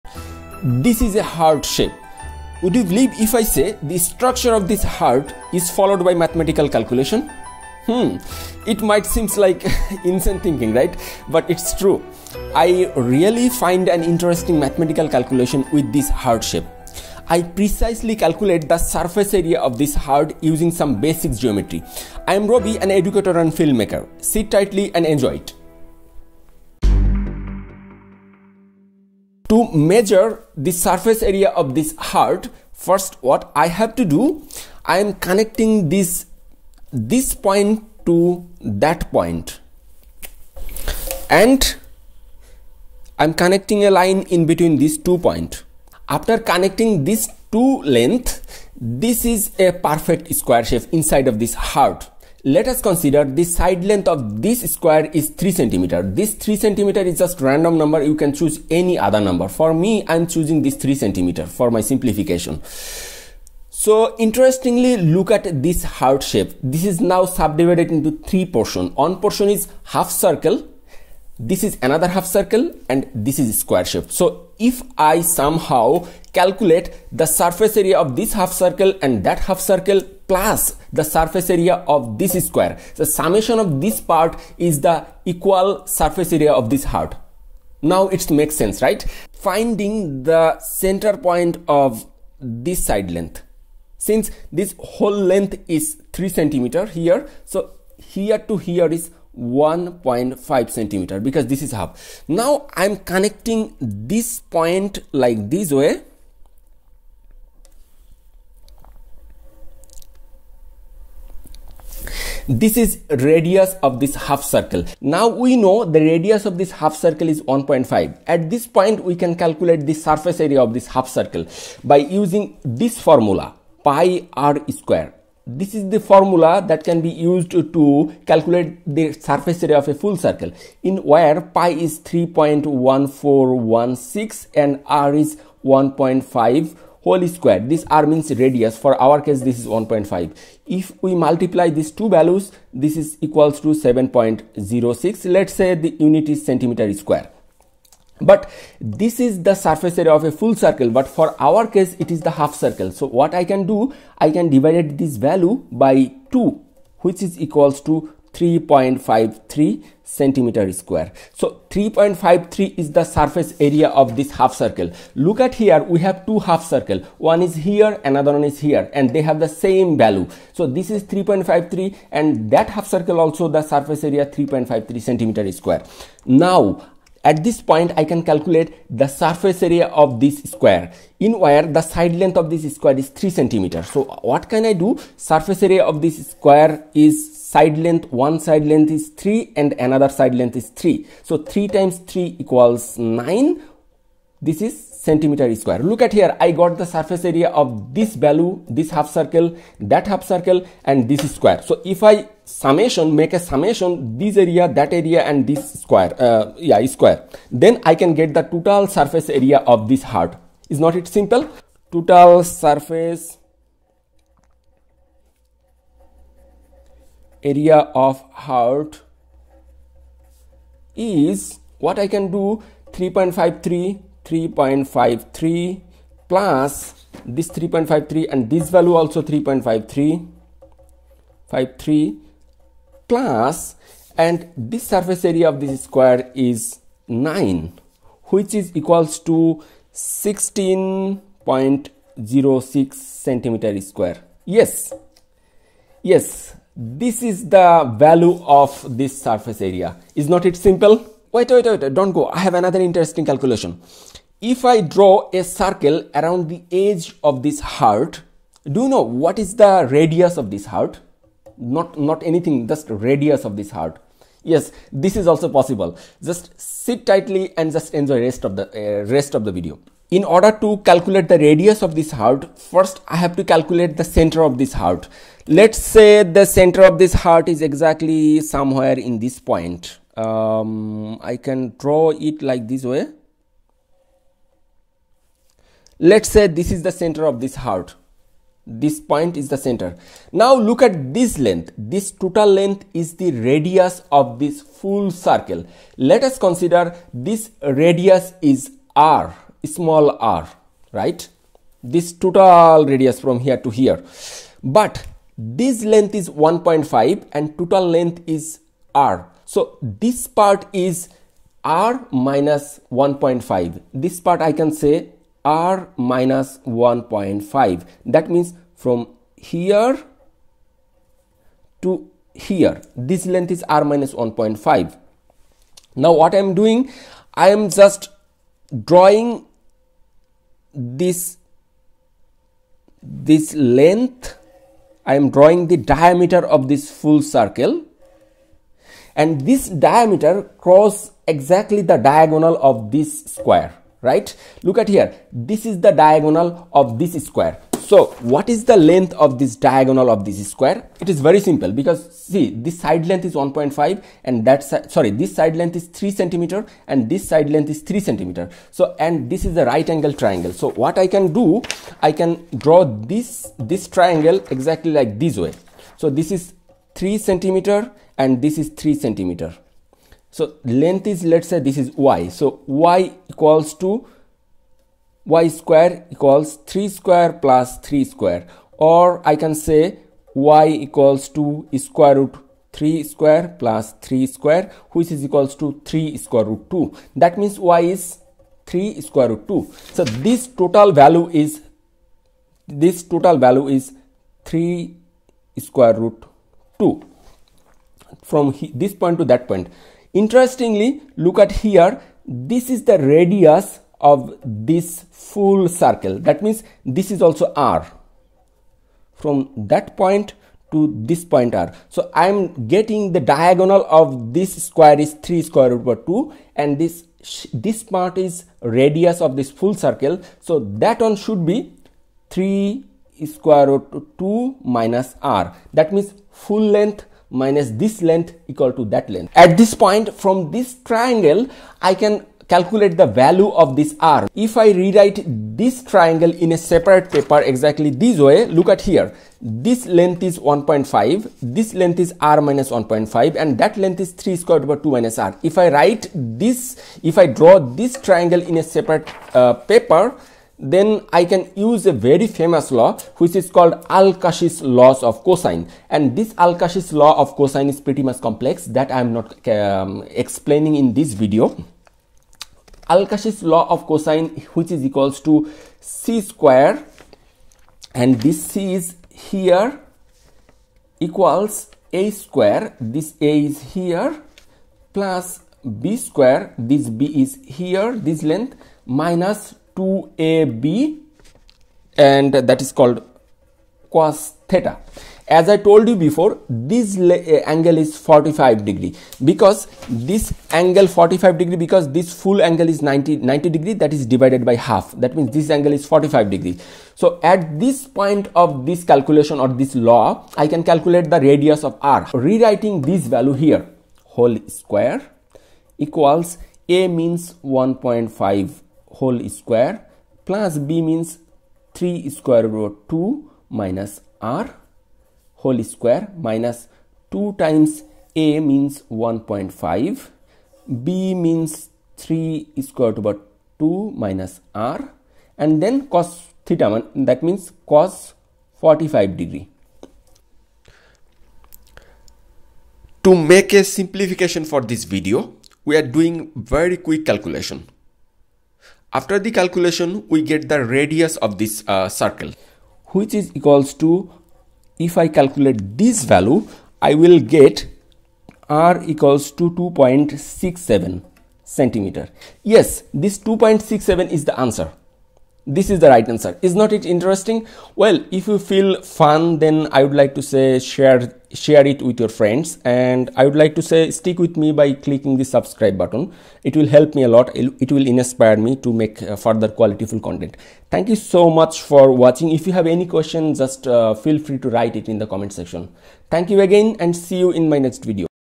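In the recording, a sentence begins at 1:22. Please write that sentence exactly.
The summation of this part is the equal surface area of this heart.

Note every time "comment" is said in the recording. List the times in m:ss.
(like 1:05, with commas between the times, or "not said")
9:35.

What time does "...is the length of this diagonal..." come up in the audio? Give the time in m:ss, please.
5:48.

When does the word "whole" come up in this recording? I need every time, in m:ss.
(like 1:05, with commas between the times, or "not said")
1:34, 2:17, 8:24, 8:28, 8:35.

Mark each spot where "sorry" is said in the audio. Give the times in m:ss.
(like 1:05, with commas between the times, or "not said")
5:54.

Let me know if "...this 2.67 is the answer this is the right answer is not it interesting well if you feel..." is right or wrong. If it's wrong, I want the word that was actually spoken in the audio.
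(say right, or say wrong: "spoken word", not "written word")
right.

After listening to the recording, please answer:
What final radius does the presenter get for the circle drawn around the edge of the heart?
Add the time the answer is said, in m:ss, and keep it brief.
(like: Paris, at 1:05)
2.67 cm, at 9:09.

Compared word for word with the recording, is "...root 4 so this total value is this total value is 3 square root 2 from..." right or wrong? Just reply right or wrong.
wrong.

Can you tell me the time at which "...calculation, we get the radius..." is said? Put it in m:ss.
8:59.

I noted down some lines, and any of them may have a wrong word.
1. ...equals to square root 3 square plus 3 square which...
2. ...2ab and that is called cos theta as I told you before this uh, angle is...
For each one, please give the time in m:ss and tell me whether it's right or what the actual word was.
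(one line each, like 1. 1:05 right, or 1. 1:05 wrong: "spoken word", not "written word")
1. 6:20 right
2. 7:59 right.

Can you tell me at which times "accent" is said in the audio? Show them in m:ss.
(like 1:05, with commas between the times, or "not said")
not said.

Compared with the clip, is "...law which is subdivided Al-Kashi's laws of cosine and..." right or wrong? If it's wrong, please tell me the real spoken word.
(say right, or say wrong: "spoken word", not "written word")
wrong: "called", not "subdivided".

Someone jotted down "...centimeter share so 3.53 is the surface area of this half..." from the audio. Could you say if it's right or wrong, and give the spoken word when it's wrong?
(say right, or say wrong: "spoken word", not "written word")
wrong: "square", not "share".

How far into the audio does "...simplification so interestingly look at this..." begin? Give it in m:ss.
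1:01.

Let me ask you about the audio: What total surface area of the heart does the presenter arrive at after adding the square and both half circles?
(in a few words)
16.06 cm².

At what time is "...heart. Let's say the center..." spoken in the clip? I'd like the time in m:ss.
4:34.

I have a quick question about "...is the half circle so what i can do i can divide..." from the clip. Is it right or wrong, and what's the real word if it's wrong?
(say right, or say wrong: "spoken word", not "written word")
right.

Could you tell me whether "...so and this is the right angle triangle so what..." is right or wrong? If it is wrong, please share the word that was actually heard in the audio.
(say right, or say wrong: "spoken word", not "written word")
right.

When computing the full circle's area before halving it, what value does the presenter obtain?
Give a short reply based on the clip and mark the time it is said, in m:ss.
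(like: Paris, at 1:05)
7.06, at 2:23.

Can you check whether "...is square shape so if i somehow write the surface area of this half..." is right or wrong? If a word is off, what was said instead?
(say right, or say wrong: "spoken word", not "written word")
wrong: "calculate", not "write".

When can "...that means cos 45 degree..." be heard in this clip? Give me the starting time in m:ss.
8:47.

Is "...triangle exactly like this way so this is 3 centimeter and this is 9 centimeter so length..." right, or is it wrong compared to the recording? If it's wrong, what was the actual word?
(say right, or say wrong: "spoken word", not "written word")
wrong: "3", not "9".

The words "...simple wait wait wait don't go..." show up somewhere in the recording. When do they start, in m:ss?
4:10.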